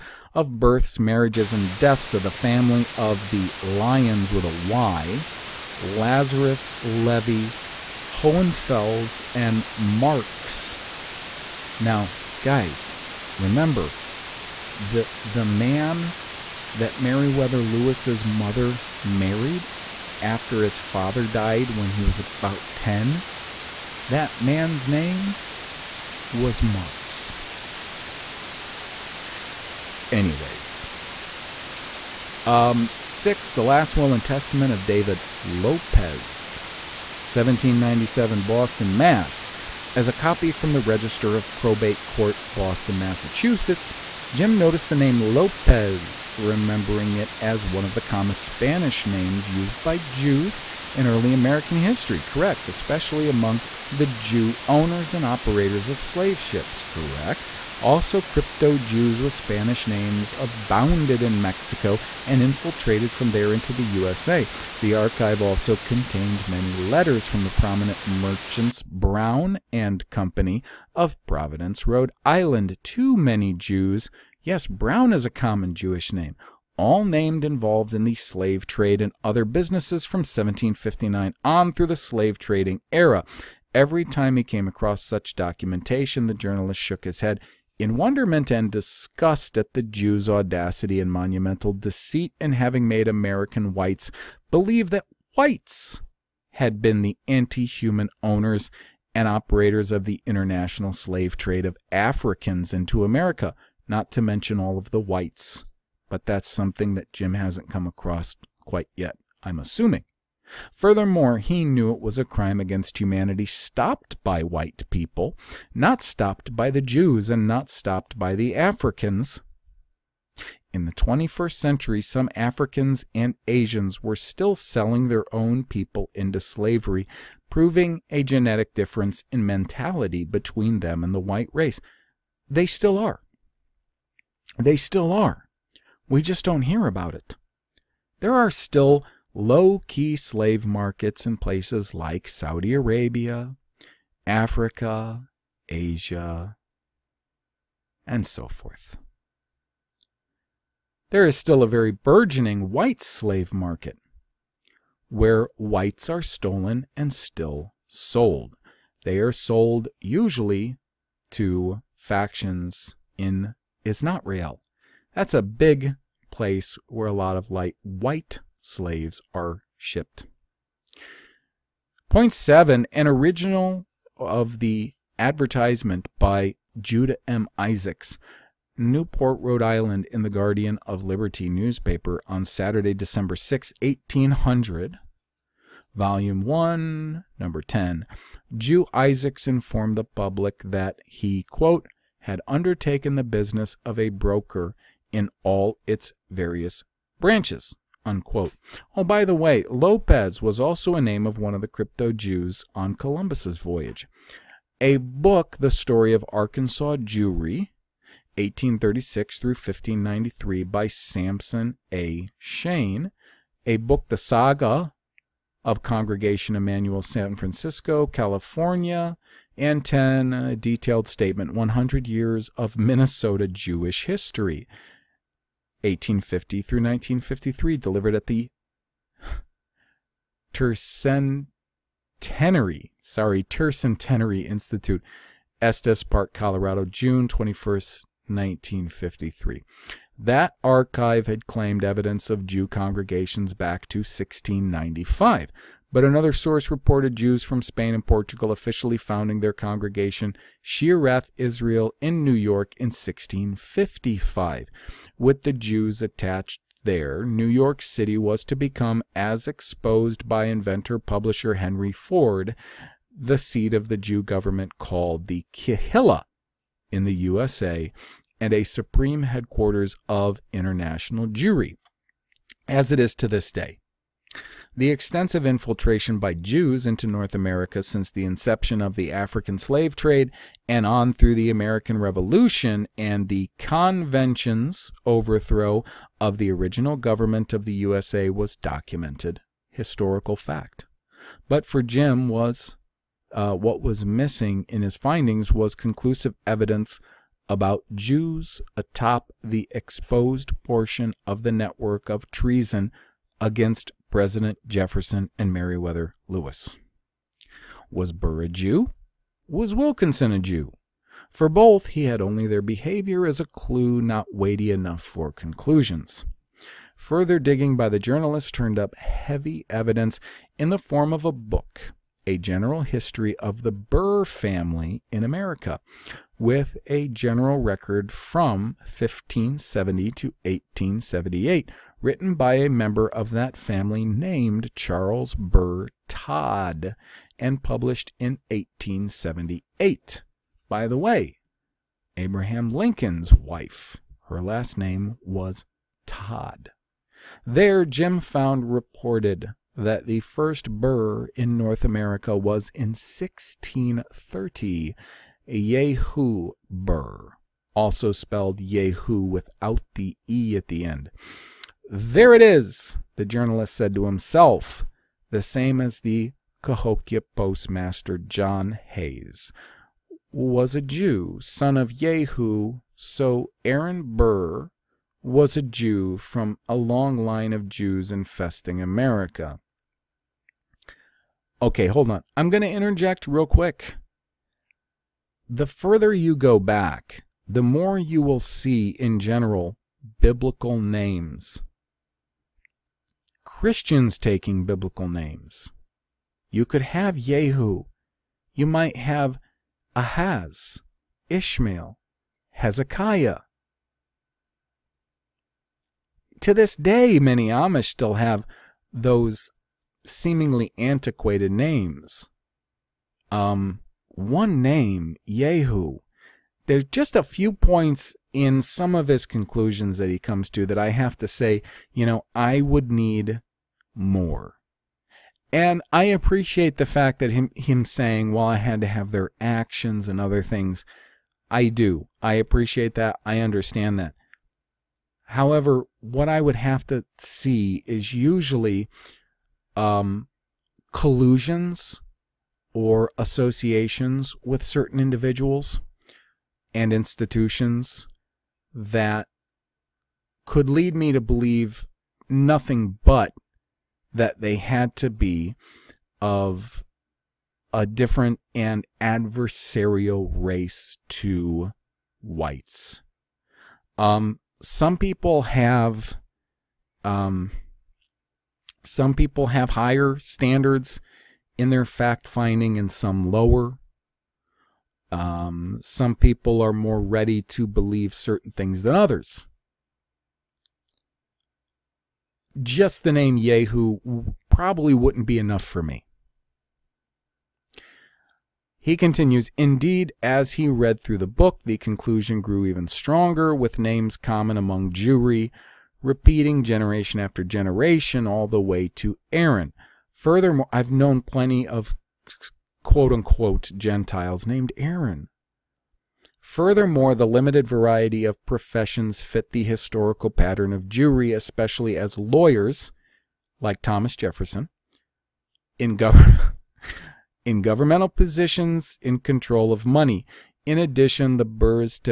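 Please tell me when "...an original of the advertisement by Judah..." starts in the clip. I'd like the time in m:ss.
2:52.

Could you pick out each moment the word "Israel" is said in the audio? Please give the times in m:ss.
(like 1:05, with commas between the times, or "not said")
2:43, 4:11.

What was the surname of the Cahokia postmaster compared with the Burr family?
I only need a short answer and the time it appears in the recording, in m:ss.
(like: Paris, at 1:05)
Hayes, at 6:08.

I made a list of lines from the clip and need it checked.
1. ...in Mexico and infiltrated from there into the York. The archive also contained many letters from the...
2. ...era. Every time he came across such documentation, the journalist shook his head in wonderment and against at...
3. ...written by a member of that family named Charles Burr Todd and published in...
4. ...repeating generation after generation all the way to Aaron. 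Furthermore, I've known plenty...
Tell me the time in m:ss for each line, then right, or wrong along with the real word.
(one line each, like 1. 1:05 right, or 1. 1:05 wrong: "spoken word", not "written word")
1. 1:01 wrong: "USA", not "York"
2. 1:22 wrong: "disgust", not "against"
3. 5:32 right
4. 8:16 right.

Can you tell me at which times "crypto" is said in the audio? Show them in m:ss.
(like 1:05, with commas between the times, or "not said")
0:58, 3:21.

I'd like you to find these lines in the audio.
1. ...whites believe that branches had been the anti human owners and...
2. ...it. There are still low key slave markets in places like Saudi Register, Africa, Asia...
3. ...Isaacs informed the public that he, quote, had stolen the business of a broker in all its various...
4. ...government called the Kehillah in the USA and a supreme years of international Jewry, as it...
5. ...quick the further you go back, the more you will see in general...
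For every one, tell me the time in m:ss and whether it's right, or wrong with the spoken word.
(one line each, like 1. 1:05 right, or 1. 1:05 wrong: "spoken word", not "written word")
1. 1:33 wrong: "whites", not "branches"
2. 2:17 wrong: "Arabia", not "Register"
3. 3:08 wrong: "undertaken", not "stolen"
4. 4:24 wrong: "headquarters", not "years"
5. 6:23 right.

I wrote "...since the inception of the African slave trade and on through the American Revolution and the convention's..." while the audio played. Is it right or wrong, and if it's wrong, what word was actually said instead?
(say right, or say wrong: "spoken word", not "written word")
right.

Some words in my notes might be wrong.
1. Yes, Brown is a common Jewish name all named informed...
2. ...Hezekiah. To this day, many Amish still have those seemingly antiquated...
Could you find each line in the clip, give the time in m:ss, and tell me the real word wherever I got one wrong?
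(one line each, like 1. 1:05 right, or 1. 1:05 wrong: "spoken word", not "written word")
1. 1:14 wrong: "involved", not "informed"
2. 6:42 right.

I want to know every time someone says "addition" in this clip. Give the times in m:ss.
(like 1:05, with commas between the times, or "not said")
8:40.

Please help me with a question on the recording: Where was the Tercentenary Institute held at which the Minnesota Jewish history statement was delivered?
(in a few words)
Estes Park, Colorado.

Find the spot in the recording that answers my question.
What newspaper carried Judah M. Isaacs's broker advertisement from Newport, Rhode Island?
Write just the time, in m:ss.
3:00.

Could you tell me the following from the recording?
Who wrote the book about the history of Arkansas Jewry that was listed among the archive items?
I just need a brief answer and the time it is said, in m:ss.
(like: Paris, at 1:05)
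Sampson A. Shane, at 3:30.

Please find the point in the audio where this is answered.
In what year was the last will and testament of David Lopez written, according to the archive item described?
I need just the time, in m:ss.
0:37.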